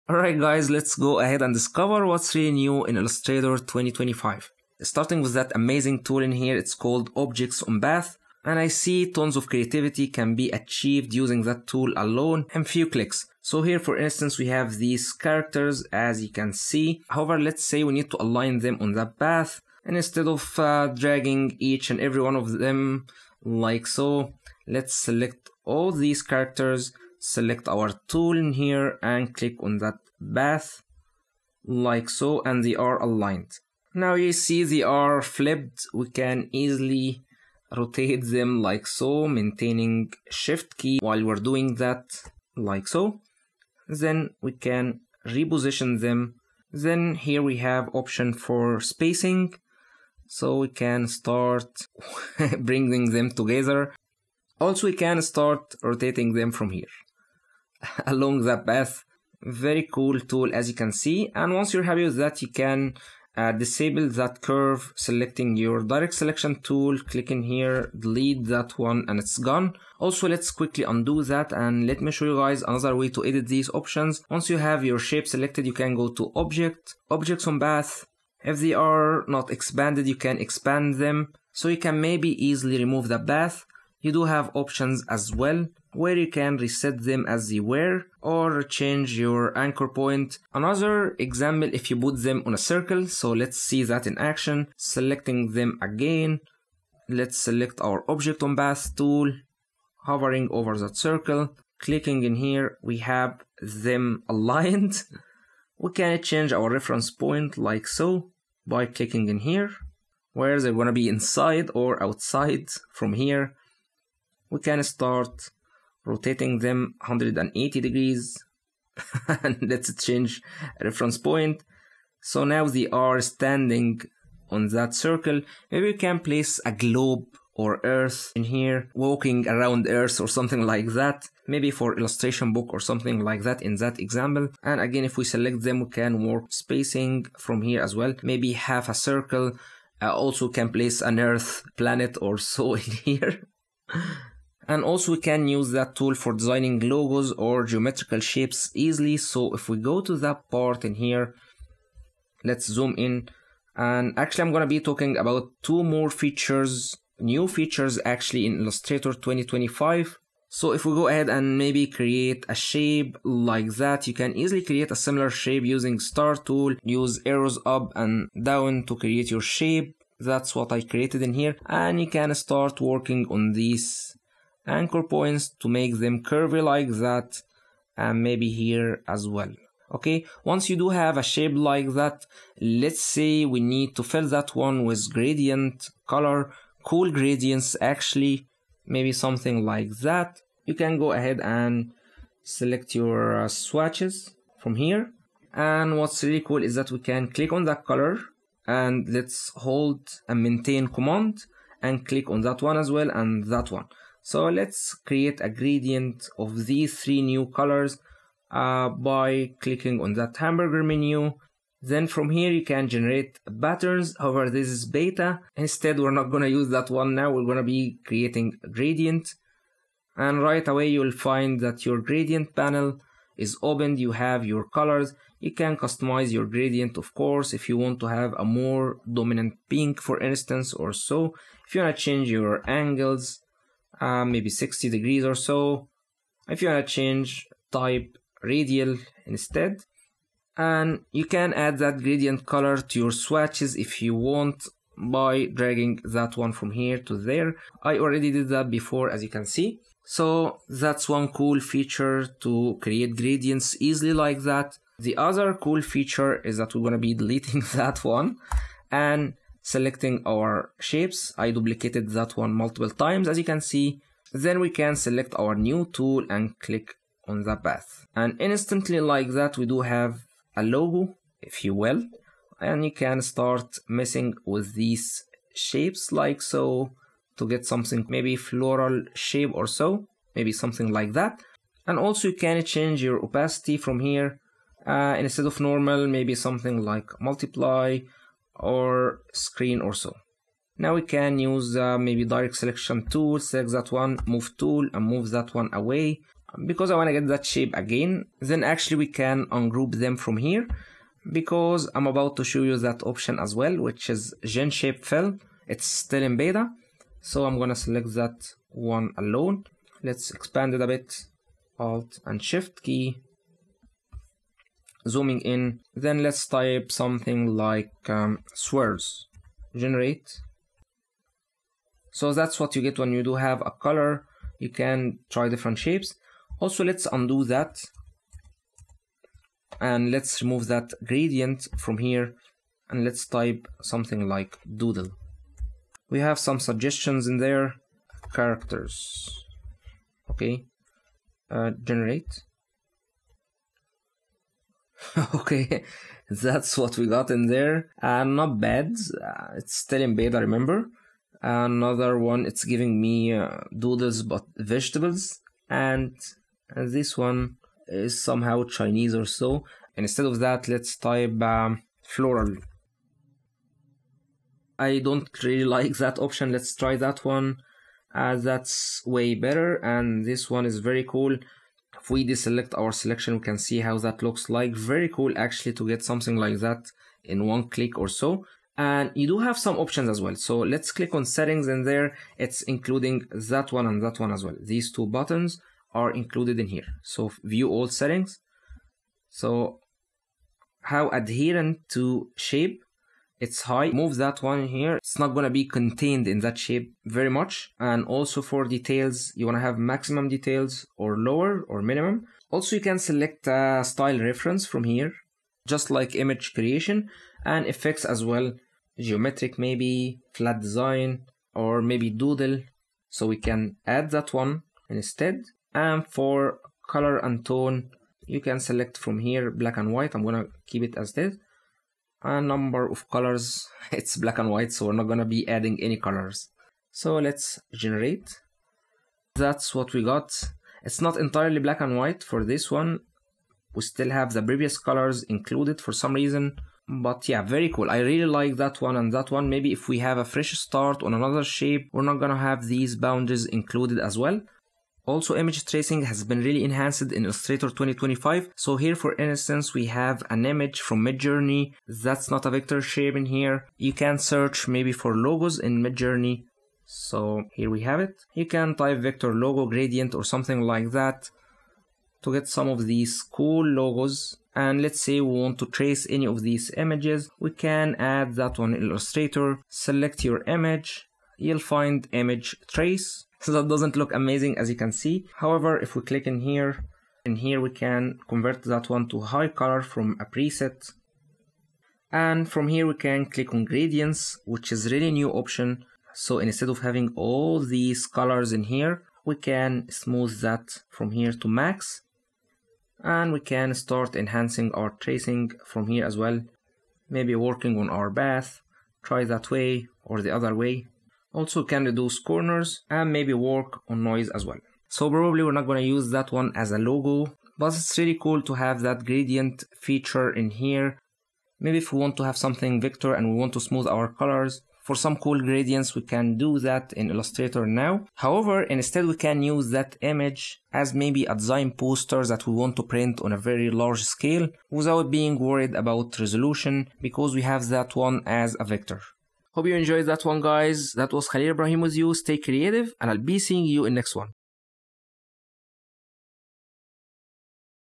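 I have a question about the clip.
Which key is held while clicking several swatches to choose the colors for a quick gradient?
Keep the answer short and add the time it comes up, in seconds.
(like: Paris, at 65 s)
Command, at 200 s.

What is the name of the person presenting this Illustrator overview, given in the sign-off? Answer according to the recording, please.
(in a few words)
Khalil Ibrahim.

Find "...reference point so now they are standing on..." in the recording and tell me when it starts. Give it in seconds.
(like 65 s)
120 s.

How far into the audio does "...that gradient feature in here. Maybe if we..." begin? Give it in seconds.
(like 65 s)
508 s.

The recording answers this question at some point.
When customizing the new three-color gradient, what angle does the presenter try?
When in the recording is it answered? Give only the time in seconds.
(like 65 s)
234 s.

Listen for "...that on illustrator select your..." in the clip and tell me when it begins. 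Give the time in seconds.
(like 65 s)
468 s.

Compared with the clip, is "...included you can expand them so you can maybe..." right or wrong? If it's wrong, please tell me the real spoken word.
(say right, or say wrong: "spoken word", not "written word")
wrong: "expanded", not "included".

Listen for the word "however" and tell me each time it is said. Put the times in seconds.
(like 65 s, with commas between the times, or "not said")
17 s, 214 s, 475 s, 518 s.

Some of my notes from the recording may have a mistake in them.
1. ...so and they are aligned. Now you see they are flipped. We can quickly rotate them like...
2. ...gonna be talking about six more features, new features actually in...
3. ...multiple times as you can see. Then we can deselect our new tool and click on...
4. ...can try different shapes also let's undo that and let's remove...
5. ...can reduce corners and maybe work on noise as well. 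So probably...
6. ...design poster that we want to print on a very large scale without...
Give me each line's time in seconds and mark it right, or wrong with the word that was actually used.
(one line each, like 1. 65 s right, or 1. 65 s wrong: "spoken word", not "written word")
1. 32 s wrong: "easily", not "quickly"
2. 154 s wrong: "two", not "six"
3. 262 s wrong: "select", not "deselect"
4. 324 s right
5. 501 s right
6. 521 s right.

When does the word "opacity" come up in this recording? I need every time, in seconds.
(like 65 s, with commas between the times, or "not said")
283 s.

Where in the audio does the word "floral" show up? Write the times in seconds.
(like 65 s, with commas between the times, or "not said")
278 s, 362 s.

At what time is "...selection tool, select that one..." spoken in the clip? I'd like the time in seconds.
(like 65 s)
292 s.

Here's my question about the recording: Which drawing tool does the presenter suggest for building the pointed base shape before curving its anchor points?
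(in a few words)
Star tool.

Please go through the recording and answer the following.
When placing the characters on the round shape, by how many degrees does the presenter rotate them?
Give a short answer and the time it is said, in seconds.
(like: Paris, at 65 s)
180, at 116 s.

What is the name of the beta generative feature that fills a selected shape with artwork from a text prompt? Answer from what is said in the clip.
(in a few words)
Gen Shape Fill.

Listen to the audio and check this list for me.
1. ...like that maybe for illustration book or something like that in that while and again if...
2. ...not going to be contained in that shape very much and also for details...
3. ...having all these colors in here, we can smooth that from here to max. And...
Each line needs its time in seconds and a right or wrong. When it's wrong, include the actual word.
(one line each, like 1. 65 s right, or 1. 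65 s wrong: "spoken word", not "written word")
1. 130 s wrong: "example", not "while"
2. 395 s right
3. 486 s right.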